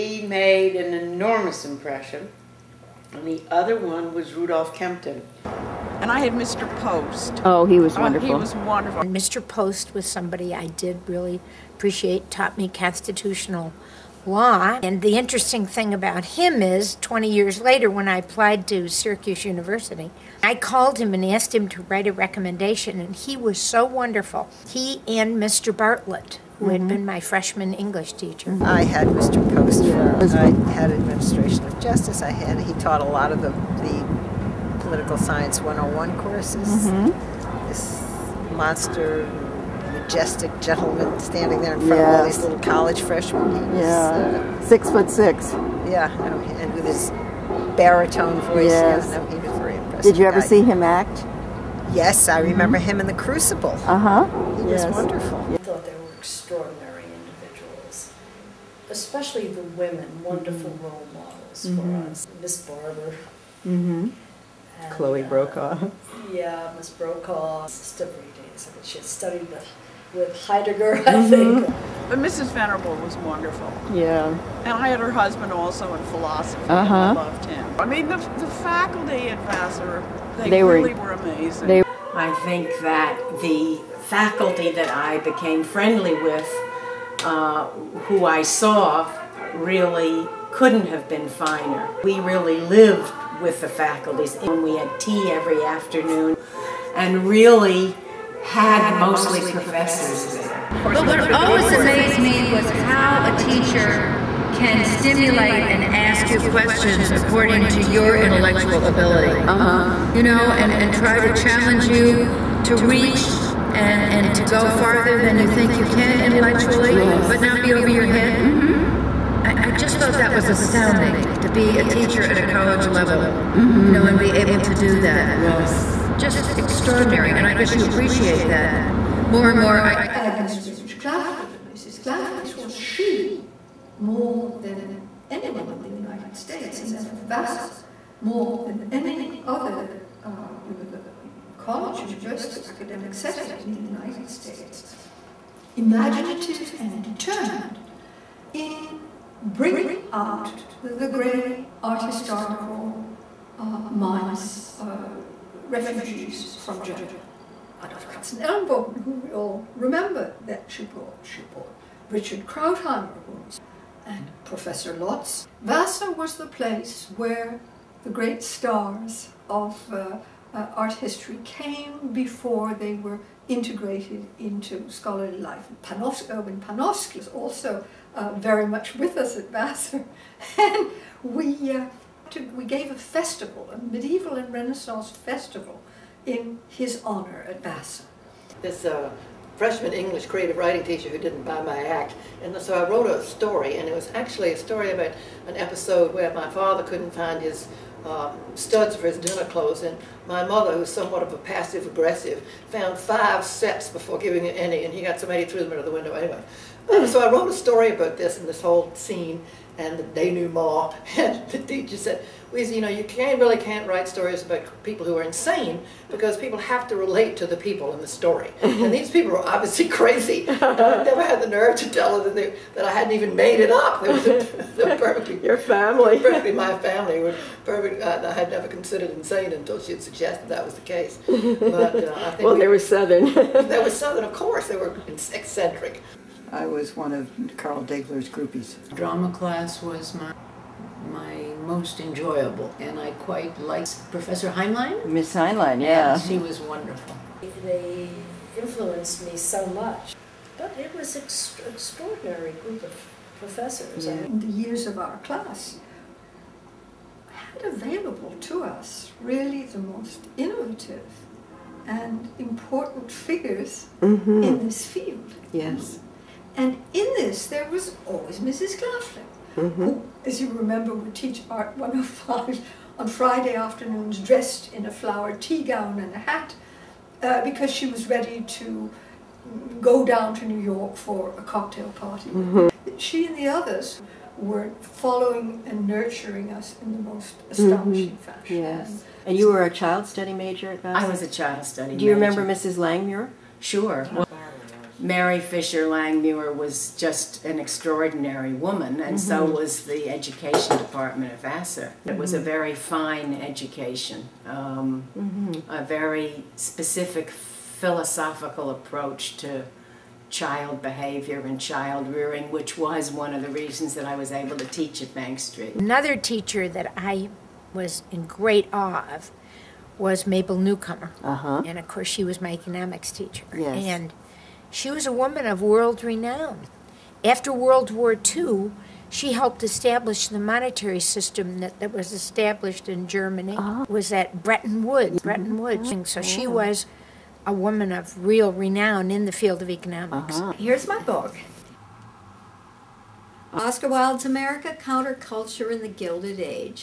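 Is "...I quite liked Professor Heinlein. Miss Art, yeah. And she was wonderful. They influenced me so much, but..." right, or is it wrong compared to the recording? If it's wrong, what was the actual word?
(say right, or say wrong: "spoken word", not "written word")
wrong: "Heinlein", not "Art".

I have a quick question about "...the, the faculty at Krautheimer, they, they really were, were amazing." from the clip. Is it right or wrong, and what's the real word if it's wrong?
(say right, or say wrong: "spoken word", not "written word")
wrong: "Vassar", not "Krautheimer".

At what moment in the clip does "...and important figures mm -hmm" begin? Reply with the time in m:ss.
4:21.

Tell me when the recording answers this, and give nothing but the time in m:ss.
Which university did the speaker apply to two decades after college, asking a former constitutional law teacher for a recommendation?
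0:18.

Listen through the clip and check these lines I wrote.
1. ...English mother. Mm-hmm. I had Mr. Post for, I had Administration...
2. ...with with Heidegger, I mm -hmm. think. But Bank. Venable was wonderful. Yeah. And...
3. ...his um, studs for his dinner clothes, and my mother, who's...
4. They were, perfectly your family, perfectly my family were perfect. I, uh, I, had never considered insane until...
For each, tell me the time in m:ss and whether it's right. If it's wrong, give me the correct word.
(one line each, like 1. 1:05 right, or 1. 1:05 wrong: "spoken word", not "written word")
1. 0:27 wrong: "teacher", not "mother"
2. 1:09 wrong: "Mrs", not "Bank"
3. 3:17 right
4. 3:44 right.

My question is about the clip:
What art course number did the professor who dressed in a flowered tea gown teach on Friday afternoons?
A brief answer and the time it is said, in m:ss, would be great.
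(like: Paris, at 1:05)
105, at 4:31.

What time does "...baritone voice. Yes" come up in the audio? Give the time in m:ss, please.
0:47.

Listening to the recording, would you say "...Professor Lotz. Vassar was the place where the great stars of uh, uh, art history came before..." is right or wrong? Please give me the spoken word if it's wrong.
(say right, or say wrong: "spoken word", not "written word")
right.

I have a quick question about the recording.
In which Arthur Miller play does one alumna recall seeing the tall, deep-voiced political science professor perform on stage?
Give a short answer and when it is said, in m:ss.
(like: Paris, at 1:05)
The Crucible, at 0:53.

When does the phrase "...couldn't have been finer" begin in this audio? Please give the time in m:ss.
1:30.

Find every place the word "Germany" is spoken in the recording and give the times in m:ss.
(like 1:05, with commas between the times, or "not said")
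2:36, 5:33.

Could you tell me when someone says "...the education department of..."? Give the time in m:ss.
4:59.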